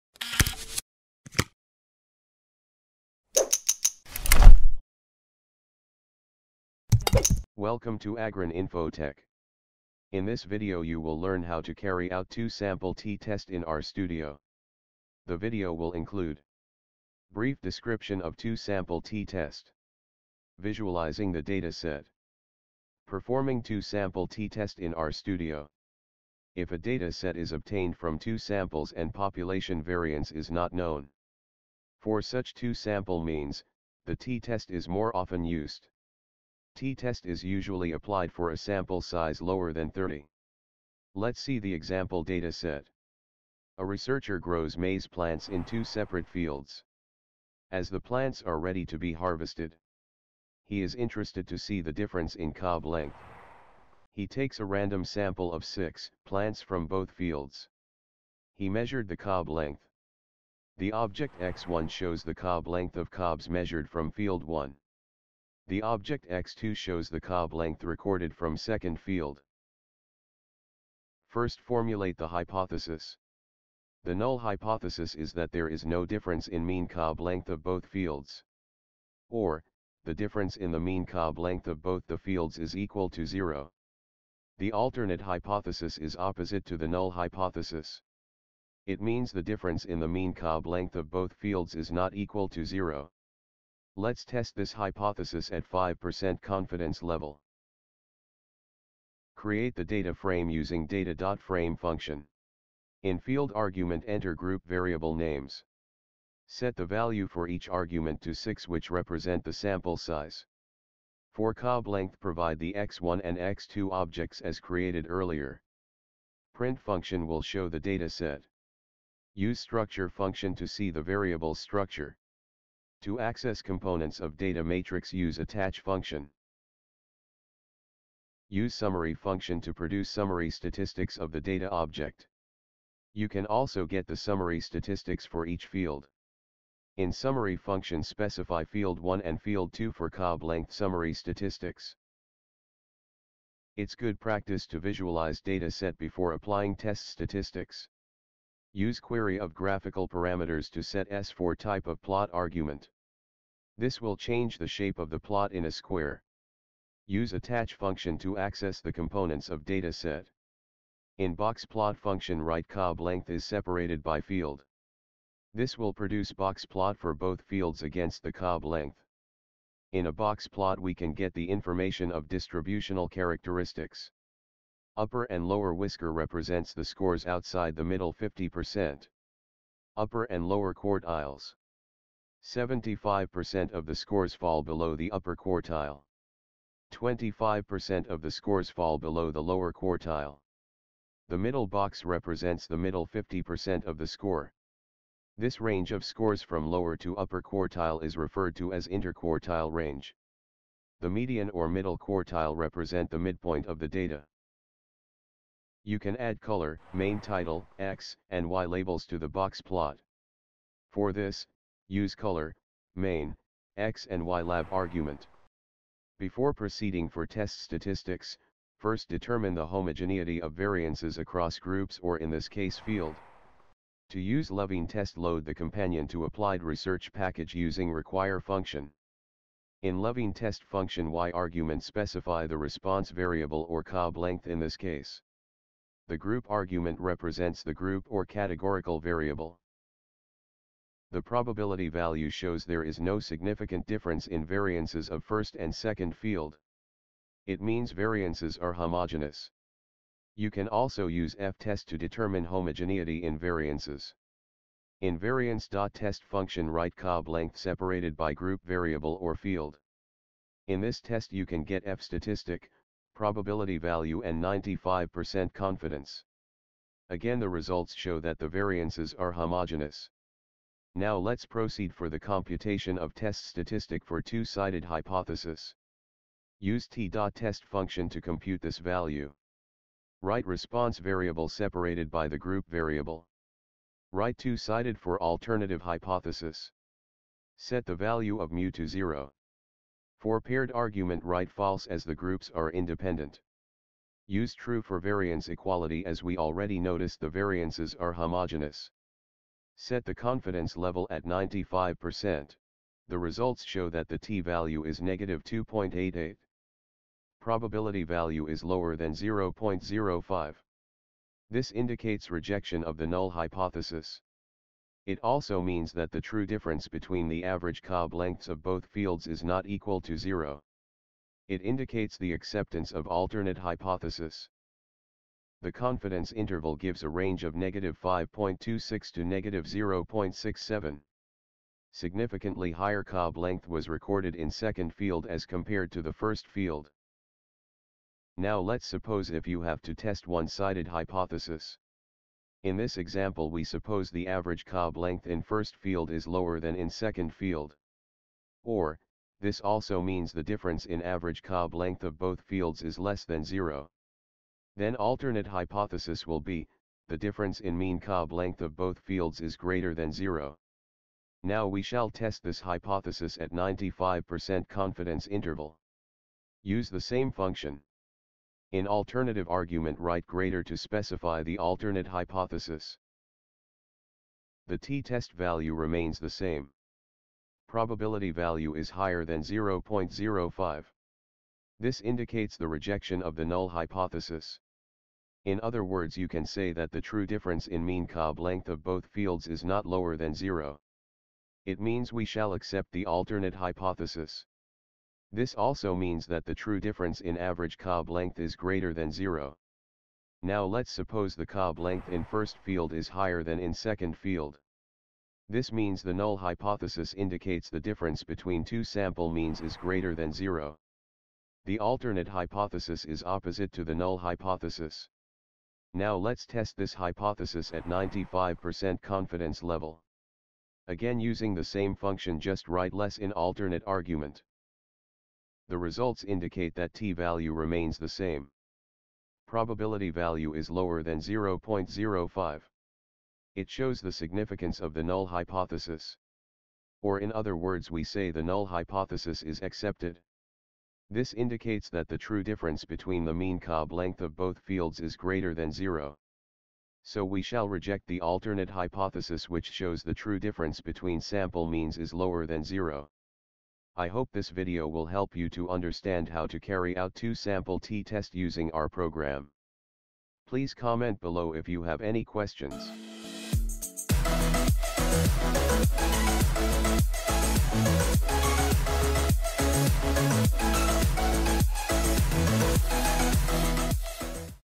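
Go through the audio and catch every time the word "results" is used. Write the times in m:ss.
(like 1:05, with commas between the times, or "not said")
4:27, 5:03, 7:05.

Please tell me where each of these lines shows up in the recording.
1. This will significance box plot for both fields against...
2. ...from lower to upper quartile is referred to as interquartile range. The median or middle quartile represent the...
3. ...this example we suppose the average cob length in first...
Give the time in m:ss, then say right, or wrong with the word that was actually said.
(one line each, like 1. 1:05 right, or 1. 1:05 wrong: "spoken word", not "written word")
1. 2:45 wrong: "produce", not "significance"
2. 3:16 right
3. 5:42 right.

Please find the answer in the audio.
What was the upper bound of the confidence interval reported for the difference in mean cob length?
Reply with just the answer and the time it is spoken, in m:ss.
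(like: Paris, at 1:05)
-0.67, at 5:29.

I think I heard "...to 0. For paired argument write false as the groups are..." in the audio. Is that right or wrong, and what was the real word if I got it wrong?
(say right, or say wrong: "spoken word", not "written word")
right.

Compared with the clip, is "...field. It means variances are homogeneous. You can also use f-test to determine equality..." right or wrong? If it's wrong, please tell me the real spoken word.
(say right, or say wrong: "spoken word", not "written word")
wrong: "homogeneity", not "equality".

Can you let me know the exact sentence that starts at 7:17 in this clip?
Or in other words we say the null hypothesis is accepted.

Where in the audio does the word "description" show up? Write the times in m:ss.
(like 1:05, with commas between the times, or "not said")
0:17.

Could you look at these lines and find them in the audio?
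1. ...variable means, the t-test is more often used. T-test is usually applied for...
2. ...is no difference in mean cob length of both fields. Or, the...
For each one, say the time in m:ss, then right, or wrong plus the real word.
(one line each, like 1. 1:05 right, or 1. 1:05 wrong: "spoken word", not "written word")
1. 0:32 wrong: "sample", not "variable"
2. 1:15 right.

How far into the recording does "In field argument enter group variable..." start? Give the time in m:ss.
1:43.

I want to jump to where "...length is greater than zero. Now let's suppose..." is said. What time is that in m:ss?
6:38.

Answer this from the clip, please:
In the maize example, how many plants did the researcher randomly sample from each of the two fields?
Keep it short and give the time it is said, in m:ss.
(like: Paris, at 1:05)
6, at 0:55.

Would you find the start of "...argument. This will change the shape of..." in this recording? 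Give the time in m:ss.
2:32.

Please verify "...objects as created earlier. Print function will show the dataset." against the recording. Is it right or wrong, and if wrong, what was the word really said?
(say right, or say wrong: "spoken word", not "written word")
right.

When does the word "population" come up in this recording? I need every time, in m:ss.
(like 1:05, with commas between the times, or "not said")
0:29.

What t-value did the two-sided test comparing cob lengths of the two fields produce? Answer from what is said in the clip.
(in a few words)
-2.88.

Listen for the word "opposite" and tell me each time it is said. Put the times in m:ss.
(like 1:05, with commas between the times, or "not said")
1:26, 6:53.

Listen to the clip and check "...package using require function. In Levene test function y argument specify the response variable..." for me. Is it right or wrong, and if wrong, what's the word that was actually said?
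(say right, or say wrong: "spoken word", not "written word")
right.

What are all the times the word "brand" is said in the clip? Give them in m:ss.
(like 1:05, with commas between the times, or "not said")
not said.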